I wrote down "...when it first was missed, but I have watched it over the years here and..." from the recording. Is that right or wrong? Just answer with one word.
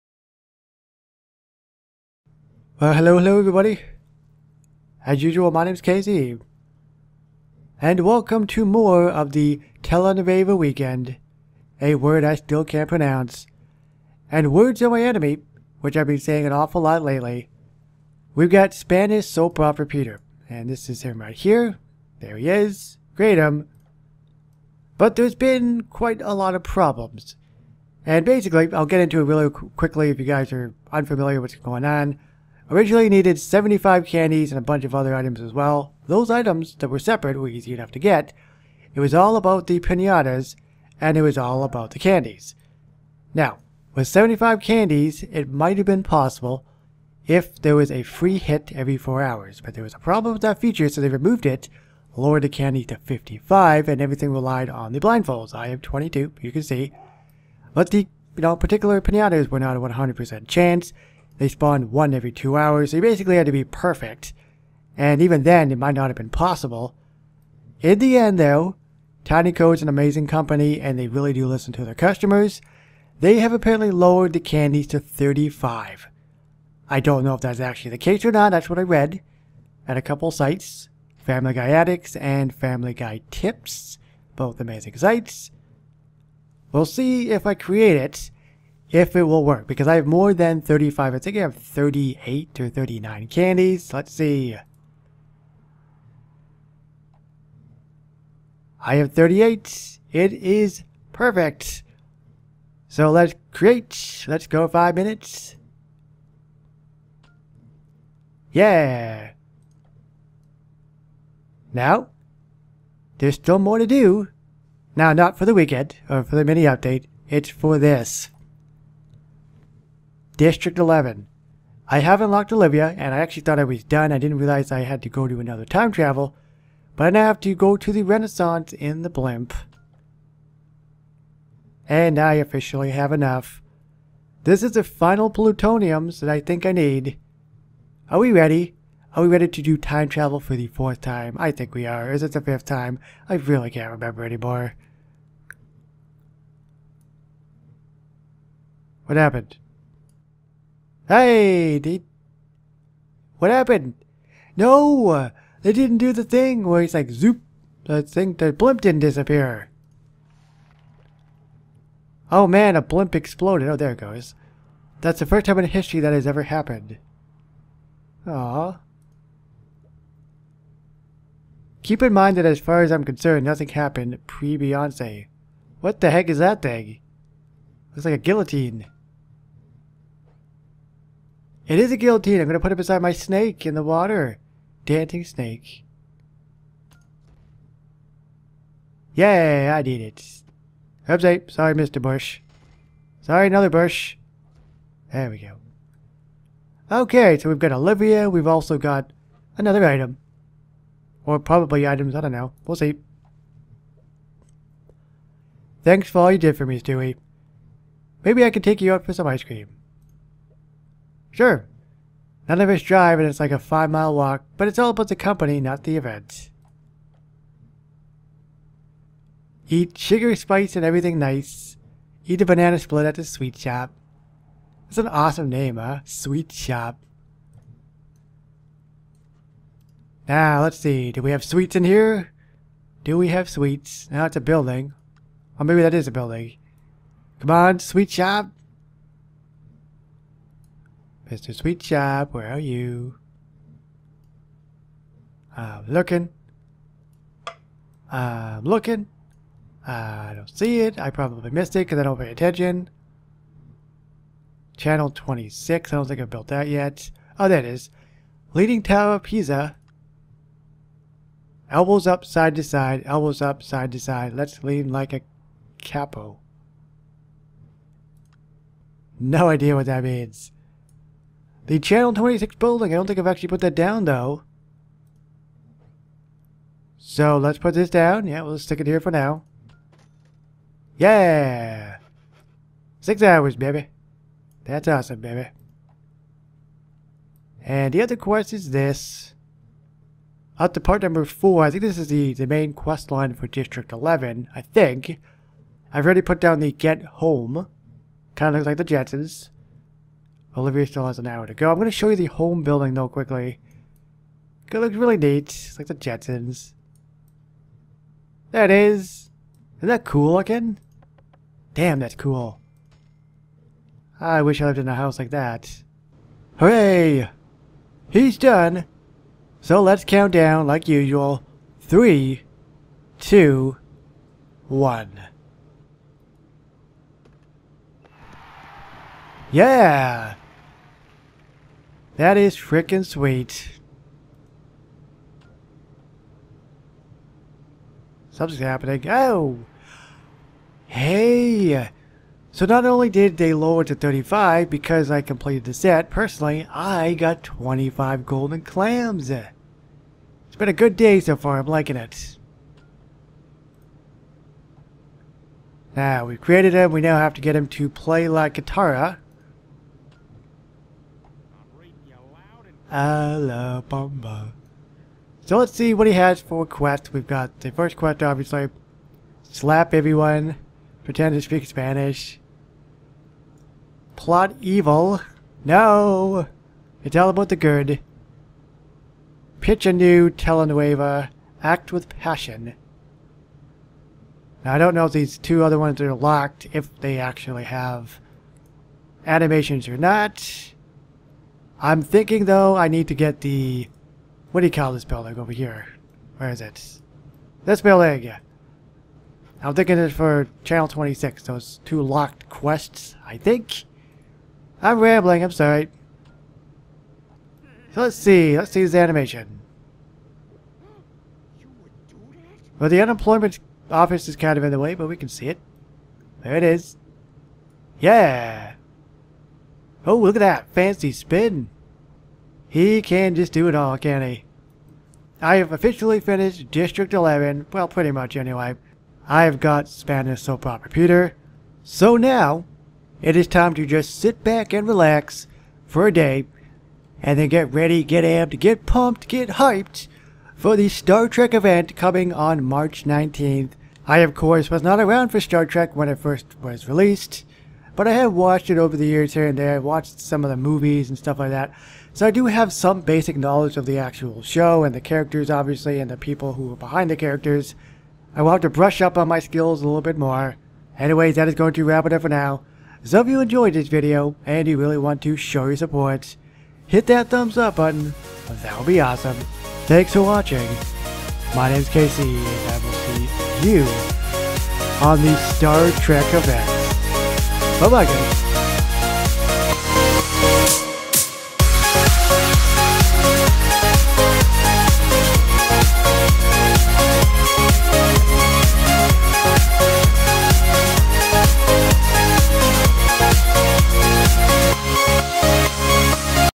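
wrong.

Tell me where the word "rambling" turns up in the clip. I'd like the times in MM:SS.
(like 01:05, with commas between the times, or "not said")
06:44.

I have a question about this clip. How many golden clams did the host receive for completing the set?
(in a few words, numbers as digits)
25.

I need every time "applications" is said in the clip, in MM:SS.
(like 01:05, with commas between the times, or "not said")
not said.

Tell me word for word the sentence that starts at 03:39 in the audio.
Eat sugar, spice, and everything nice.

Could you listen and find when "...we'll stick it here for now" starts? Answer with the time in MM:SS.
04:38.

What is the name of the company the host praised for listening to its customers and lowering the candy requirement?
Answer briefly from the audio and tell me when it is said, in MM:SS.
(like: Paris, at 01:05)
Tinyco, at 01:09.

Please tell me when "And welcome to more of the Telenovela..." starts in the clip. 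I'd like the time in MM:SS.
00:07.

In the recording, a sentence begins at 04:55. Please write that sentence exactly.
I've already put down the Get Home.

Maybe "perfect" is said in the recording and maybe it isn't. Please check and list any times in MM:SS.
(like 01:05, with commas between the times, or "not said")
01:03, 01:41.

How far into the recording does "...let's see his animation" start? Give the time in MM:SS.
06:48.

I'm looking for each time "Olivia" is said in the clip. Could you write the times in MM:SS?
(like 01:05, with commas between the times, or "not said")
02:02, 03:17, 05:00.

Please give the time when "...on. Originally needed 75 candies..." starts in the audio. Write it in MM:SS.
00:31.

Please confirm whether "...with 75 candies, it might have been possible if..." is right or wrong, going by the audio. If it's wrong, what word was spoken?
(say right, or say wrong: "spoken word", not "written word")
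right.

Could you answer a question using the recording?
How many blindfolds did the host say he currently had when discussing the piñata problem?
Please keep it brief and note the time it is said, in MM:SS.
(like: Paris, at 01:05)
22, at 00:55.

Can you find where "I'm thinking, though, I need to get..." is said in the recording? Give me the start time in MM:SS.
06:31.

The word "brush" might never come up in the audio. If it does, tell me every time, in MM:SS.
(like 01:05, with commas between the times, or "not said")
07:38.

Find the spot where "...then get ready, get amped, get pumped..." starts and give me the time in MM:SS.
07:17.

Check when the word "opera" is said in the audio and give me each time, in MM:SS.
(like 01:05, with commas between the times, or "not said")
00:19, 07:10.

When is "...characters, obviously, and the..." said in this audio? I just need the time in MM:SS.
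07:35.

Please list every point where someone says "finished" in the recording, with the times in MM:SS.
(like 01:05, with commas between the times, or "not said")
07:06.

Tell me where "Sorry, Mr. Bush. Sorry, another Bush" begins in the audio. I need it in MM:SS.
03:11.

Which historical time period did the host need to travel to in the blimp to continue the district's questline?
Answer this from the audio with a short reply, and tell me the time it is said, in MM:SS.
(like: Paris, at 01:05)
The Renaissance, at 02:08.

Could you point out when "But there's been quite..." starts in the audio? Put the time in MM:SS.
00:24.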